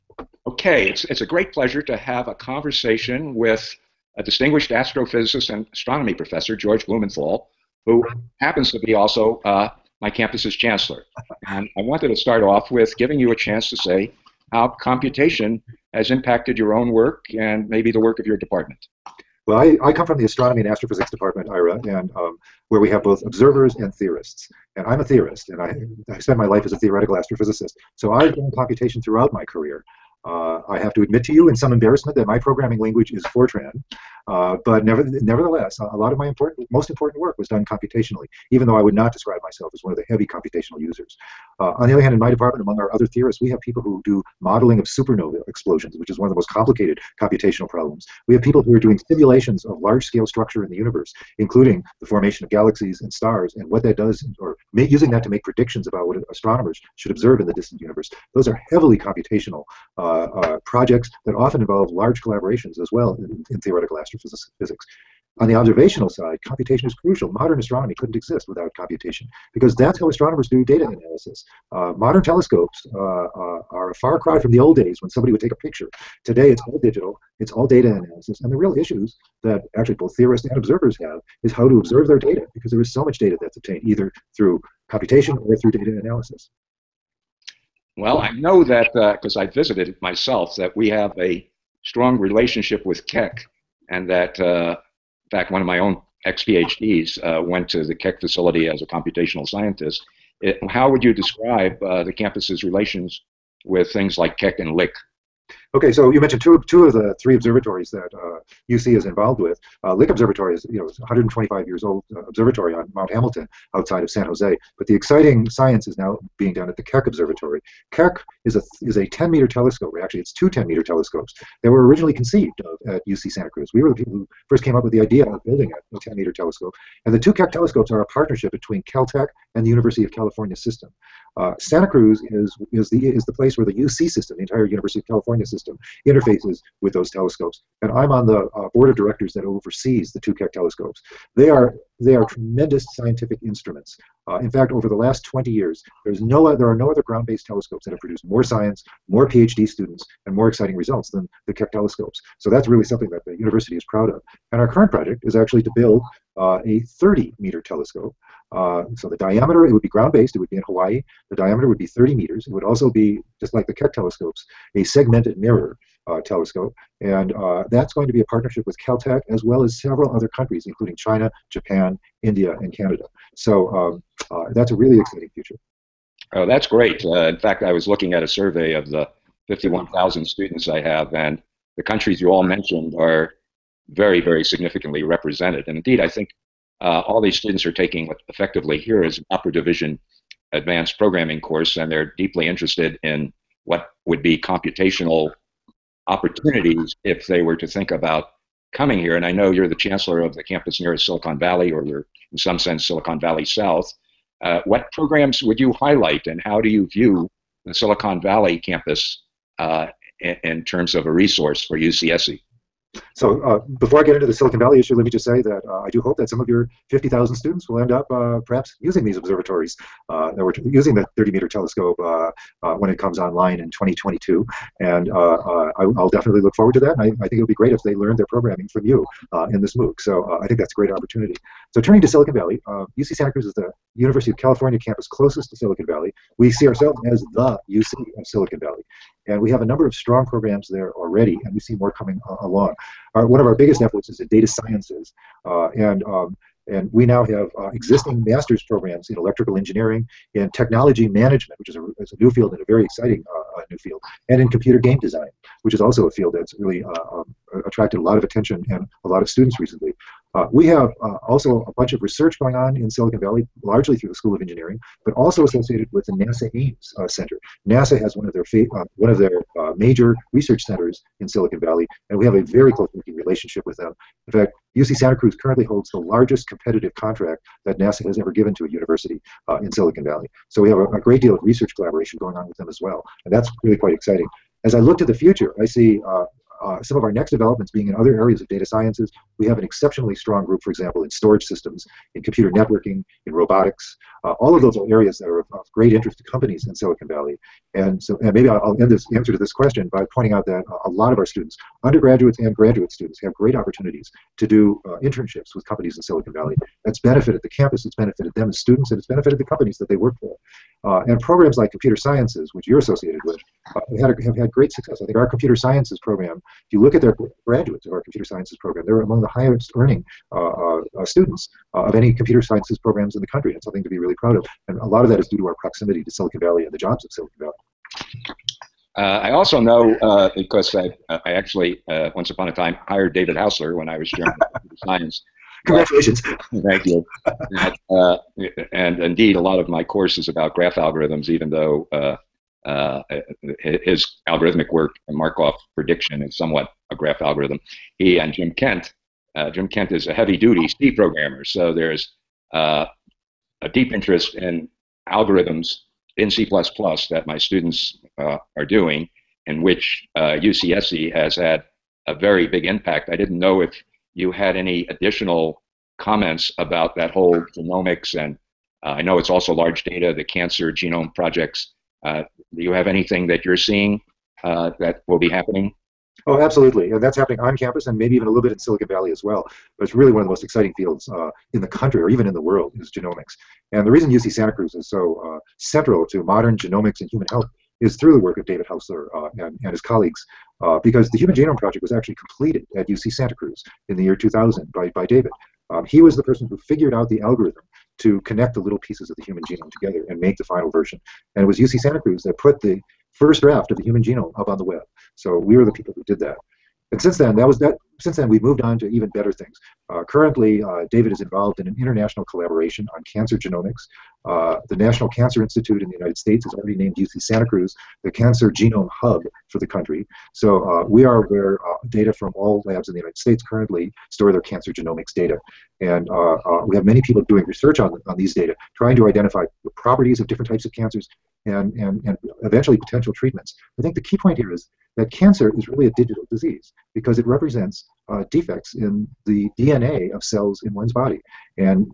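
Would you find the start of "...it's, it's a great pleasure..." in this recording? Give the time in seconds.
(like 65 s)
0 s.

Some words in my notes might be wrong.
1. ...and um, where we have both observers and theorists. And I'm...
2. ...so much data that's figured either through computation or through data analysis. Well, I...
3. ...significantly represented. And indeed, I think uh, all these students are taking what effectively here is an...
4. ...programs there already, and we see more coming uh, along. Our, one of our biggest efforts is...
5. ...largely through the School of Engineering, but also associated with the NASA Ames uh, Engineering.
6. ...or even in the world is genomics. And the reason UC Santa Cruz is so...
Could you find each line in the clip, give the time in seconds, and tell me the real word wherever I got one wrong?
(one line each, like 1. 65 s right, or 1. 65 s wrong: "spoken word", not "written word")
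1. 21 s right
2. 82 s wrong: "obtained", not "figured"
3. 184 s right
4. 240 s right
5. 263 s wrong: "Center", not "Engineering"
6. 382 s right.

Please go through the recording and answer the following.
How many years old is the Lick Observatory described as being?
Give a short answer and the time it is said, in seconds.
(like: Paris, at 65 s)
125, at 110 s.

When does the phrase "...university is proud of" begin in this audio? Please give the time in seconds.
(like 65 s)
153 s.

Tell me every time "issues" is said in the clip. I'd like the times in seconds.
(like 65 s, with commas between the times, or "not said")
78 s, 214 s.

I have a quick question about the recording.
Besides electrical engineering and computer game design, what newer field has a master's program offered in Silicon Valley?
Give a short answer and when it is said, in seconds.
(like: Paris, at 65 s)
technology management, at 250 s.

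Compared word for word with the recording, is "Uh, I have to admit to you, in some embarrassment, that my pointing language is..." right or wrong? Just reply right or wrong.
wrong.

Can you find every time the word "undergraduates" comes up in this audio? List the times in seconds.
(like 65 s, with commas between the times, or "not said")
301 s.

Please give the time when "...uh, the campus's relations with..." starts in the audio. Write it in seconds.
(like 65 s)
101 s.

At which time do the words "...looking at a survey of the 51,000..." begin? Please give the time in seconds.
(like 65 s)
177 s.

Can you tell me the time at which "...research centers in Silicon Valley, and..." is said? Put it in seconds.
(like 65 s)
270 s.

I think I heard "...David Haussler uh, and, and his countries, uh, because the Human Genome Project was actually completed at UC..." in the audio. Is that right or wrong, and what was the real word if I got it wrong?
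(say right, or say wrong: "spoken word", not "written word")
wrong: "colleagues", not "countries".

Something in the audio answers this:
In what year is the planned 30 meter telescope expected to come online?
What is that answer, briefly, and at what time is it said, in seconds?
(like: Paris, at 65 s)
2022, at 223 s.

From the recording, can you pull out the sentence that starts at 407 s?
Since then, we've moved on to even better things.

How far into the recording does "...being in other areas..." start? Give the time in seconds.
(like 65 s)
287 s.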